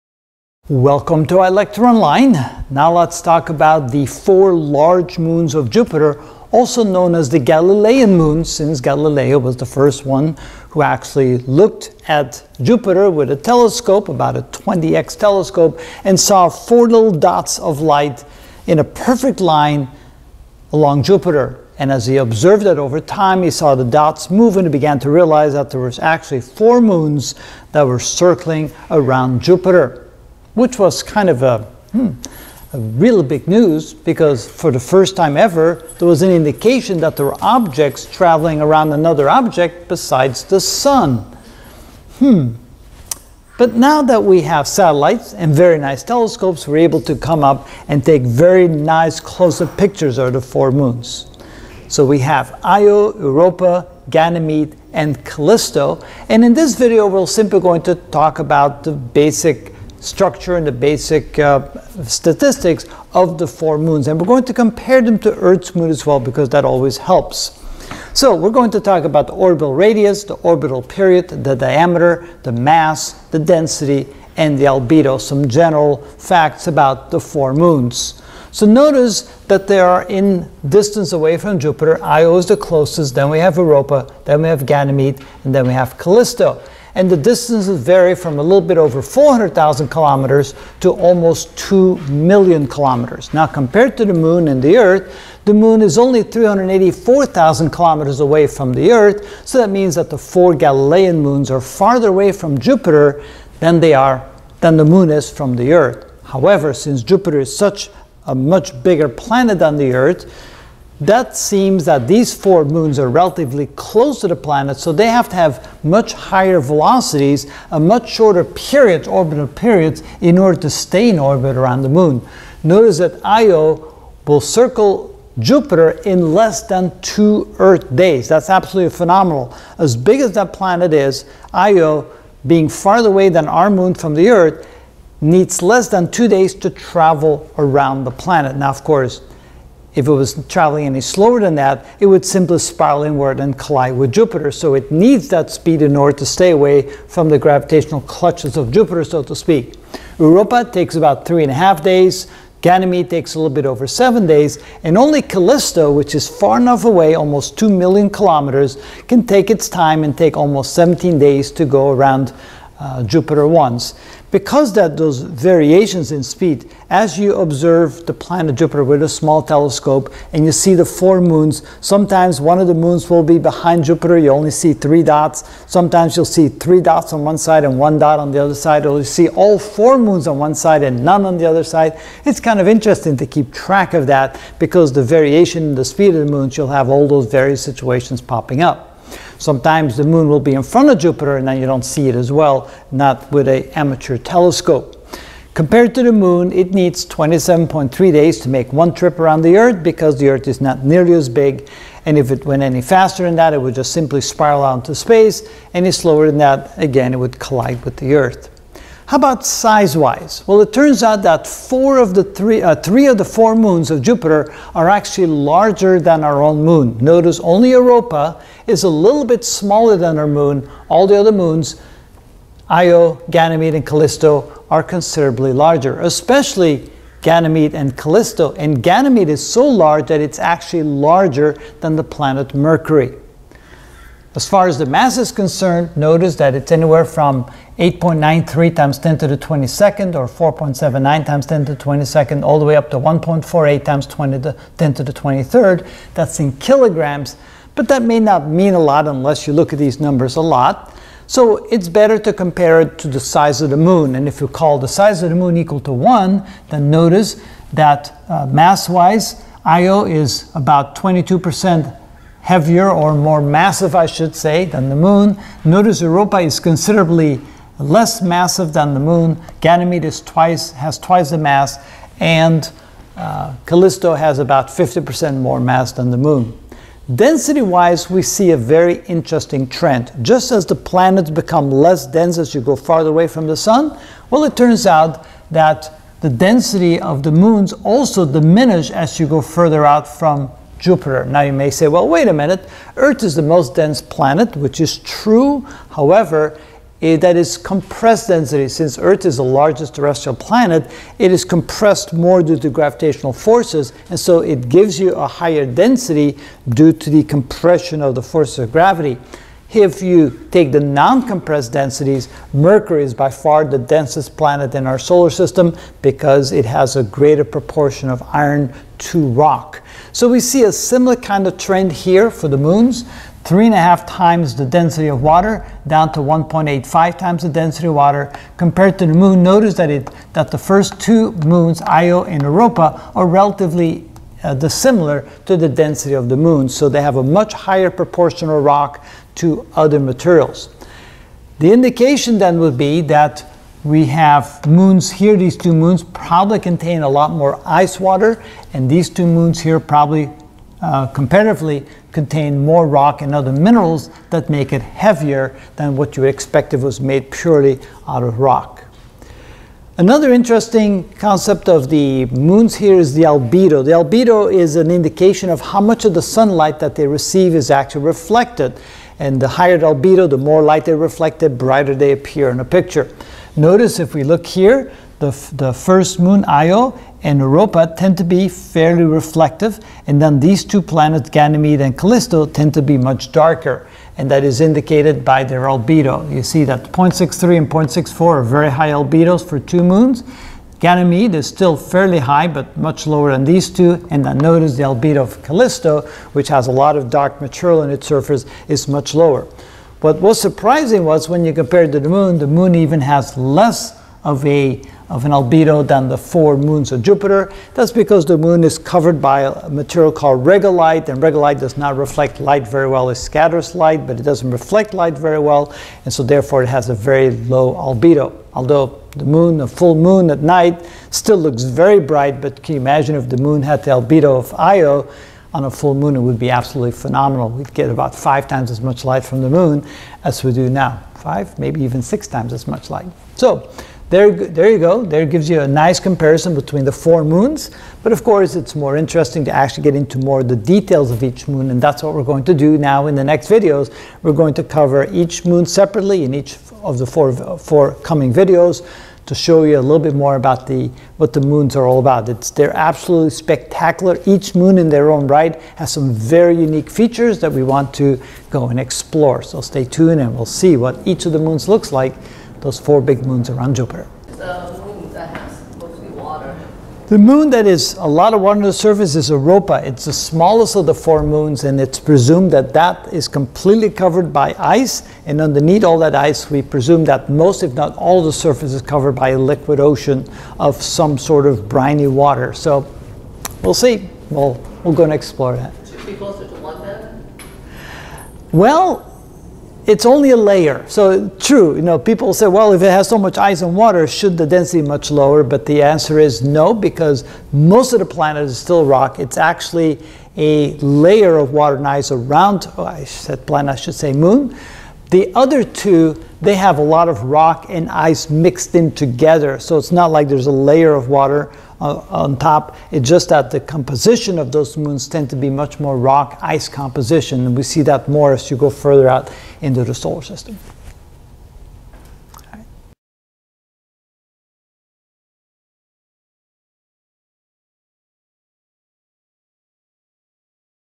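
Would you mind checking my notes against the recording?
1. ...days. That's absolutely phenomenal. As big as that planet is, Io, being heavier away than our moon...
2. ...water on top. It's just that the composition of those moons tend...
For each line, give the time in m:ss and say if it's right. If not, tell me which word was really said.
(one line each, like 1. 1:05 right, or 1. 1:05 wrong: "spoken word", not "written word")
1. 2:07 wrong: "farther", not "heavier"
2. 8:31 right.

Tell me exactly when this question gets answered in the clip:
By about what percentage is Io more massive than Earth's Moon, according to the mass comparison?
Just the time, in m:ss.
4:20.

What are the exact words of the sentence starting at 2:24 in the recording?
So it needs that speed in order to stay away from the gravitational clutches of Jupiter, so to speak.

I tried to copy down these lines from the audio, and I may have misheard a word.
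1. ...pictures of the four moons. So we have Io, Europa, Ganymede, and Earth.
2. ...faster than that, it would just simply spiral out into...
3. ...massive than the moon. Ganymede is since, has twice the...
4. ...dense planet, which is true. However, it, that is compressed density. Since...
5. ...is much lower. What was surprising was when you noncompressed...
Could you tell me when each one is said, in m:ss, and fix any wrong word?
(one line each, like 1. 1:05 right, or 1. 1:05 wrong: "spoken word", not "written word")
1. 0:49 wrong: "Callisto", not "Earth"
2. 3:22 right
3. 4:28 wrong: "twice", not "since"
4. 4:53 right
5. 6:38 wrong: "compared", not "noncompressed".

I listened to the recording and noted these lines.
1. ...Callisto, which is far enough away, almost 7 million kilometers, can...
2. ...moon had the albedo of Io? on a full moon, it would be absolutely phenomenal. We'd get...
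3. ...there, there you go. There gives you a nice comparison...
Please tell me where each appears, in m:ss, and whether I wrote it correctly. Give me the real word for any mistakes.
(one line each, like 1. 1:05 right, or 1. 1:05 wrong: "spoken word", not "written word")
1. 2:35 wrong: "2", not "7"
2. 7:03 right
3. 7:14 right.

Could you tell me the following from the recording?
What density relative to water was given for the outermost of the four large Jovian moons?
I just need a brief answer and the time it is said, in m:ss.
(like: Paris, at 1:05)
1.85, at 5:26.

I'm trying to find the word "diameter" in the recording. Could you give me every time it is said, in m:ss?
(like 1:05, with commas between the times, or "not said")
1:11.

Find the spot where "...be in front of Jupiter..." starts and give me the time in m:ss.
3:10.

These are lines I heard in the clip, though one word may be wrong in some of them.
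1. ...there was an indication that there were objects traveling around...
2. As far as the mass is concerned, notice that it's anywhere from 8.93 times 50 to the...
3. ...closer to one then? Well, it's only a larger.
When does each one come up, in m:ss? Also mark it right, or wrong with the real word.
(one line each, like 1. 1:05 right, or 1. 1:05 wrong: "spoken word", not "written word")
1. 0:35 right
2. 3:54 wrong: "10", not "50"
3. 8:06 wrong: "layer", not "larger".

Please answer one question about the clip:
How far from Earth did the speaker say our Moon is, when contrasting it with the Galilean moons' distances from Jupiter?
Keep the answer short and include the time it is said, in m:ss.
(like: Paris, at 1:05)
384,000 kilometers, at 1:36.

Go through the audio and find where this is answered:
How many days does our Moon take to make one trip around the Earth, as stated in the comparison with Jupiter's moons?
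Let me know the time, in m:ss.
3:17.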